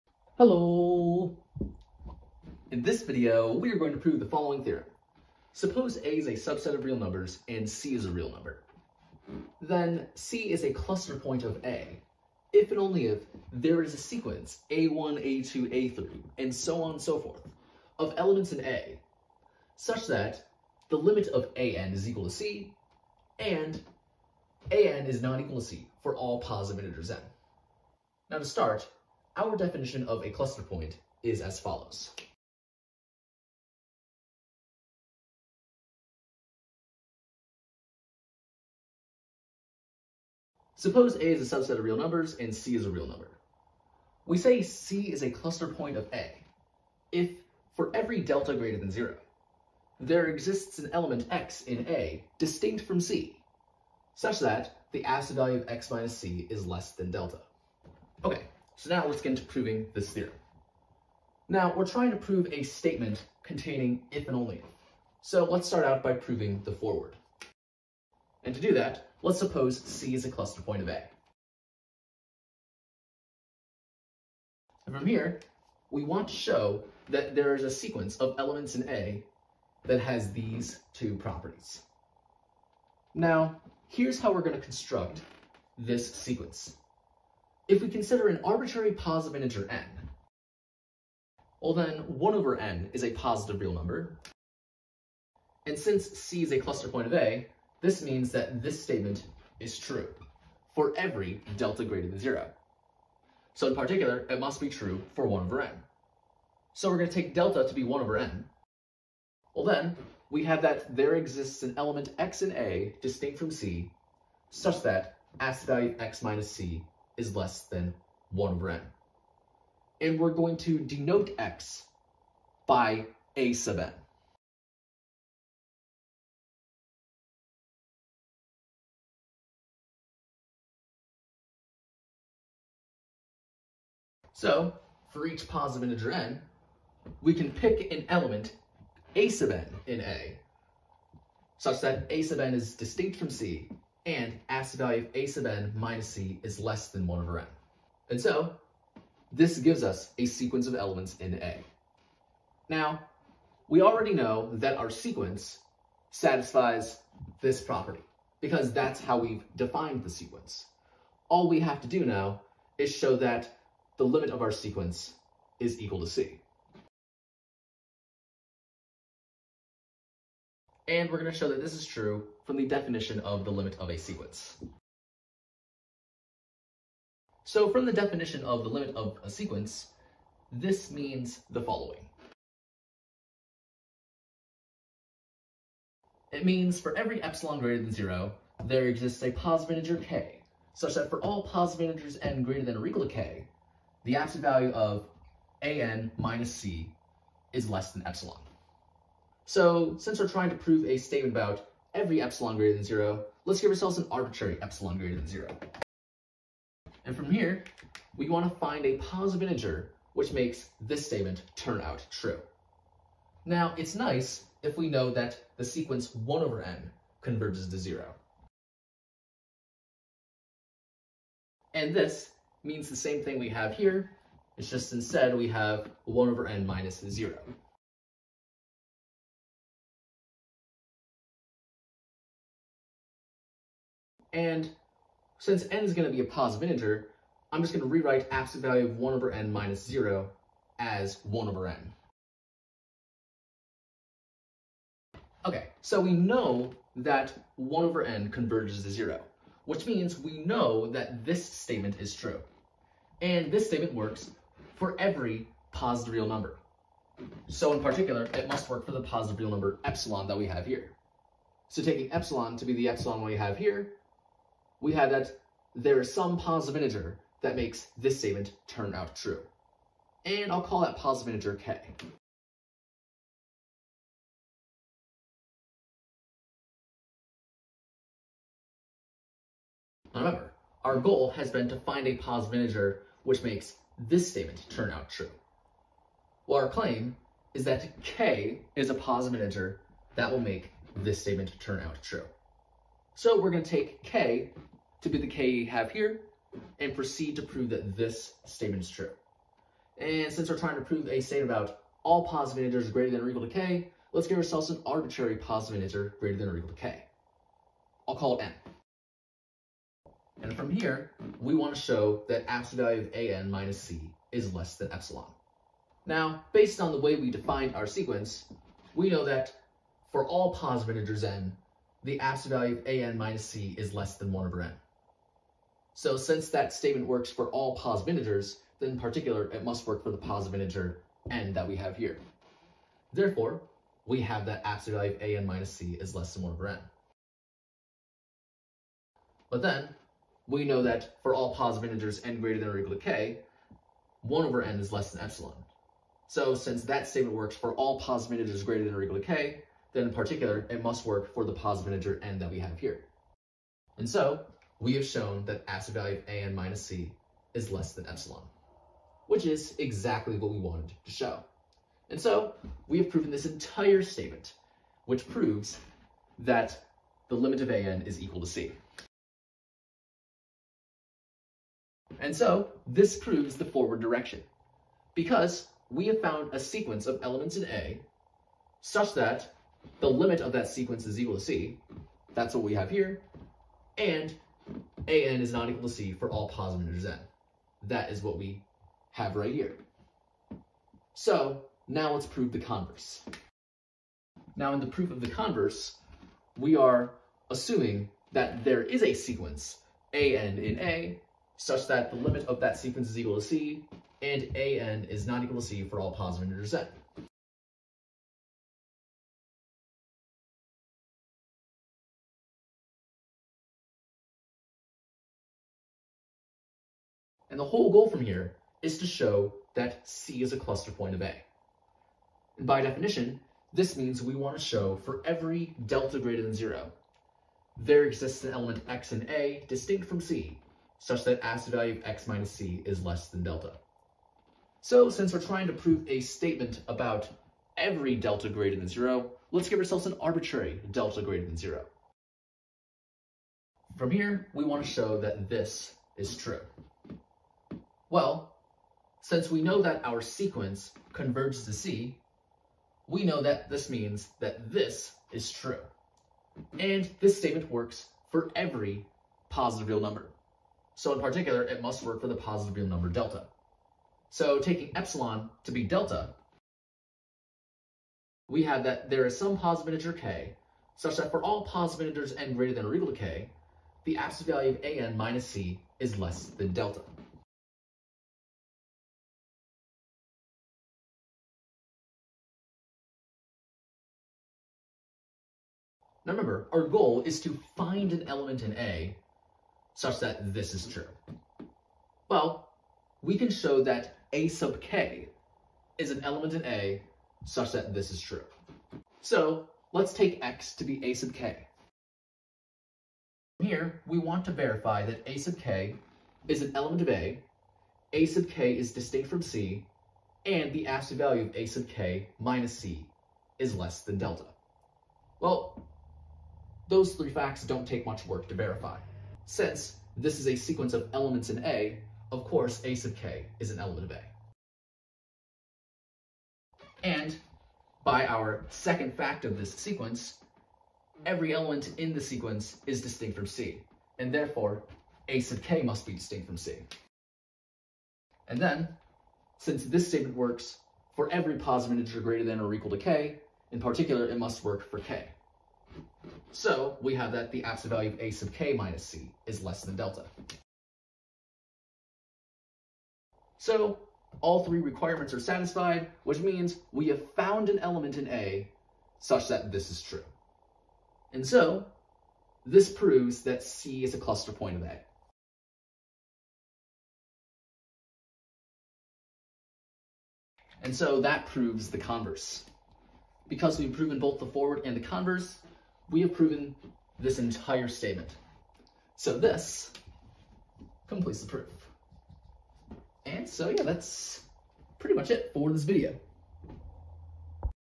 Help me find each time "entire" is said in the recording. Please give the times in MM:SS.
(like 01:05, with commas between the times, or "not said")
06:03, 09:37.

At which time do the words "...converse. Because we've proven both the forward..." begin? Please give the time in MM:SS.
09:31.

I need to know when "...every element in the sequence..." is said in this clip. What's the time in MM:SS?
08:51.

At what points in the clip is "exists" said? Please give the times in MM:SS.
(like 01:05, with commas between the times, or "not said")
00:50, 01:51, 03:08, 07:08.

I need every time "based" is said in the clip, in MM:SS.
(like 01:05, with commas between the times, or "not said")
05:16.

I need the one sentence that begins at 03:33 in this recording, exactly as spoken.
Now, it's nice if we know that the sequence 1 over n converges to 0.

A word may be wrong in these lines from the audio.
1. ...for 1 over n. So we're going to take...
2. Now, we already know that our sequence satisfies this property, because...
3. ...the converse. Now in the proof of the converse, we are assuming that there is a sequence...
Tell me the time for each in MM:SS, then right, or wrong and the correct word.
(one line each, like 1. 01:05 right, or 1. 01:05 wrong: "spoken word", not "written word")
1. 01:45 right
2. 02:32 right
3. 06:32 right.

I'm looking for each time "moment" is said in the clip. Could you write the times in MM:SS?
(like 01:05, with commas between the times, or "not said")
not said.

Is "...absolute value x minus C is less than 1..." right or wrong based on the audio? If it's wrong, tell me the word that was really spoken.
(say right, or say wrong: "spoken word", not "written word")
right.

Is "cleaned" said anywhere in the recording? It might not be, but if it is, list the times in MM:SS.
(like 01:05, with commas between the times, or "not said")
not said.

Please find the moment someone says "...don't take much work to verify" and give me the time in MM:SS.
08:37.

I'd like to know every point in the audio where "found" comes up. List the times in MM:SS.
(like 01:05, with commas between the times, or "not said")
06:16, 09:17.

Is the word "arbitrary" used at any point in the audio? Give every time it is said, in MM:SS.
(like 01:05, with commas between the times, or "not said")
01:28, 03:24, 05:04, 07:20.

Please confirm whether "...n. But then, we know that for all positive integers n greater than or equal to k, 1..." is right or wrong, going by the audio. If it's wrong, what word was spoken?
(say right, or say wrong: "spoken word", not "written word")
right.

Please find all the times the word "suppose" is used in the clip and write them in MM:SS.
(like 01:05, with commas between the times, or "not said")
00:05, 00:40, 01:09.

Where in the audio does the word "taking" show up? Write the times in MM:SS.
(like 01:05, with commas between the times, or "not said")
04:21, 07:44.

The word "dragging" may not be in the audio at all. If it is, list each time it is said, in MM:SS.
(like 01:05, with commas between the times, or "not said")
not said.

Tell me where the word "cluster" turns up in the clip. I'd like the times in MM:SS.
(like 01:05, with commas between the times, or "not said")
00:10, 00:30, 00:45, 01:10, 01:36, 07:00, 09:24.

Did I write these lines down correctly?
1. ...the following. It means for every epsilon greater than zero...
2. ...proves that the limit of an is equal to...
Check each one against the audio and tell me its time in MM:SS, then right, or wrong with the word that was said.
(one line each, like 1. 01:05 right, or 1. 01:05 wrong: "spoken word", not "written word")
1. 03:01 right
2. 06:05 right.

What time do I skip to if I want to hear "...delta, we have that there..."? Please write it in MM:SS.
07:45.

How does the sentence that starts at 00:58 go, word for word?
Okay, so now let's get into proving this theorem.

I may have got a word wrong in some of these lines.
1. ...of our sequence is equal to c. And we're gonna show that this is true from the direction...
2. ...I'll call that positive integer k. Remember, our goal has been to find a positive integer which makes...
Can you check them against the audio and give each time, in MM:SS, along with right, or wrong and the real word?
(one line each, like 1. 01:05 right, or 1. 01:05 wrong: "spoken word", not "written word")
1. 02:44 wrong: "definition", not "direction"
2. 04:30 right.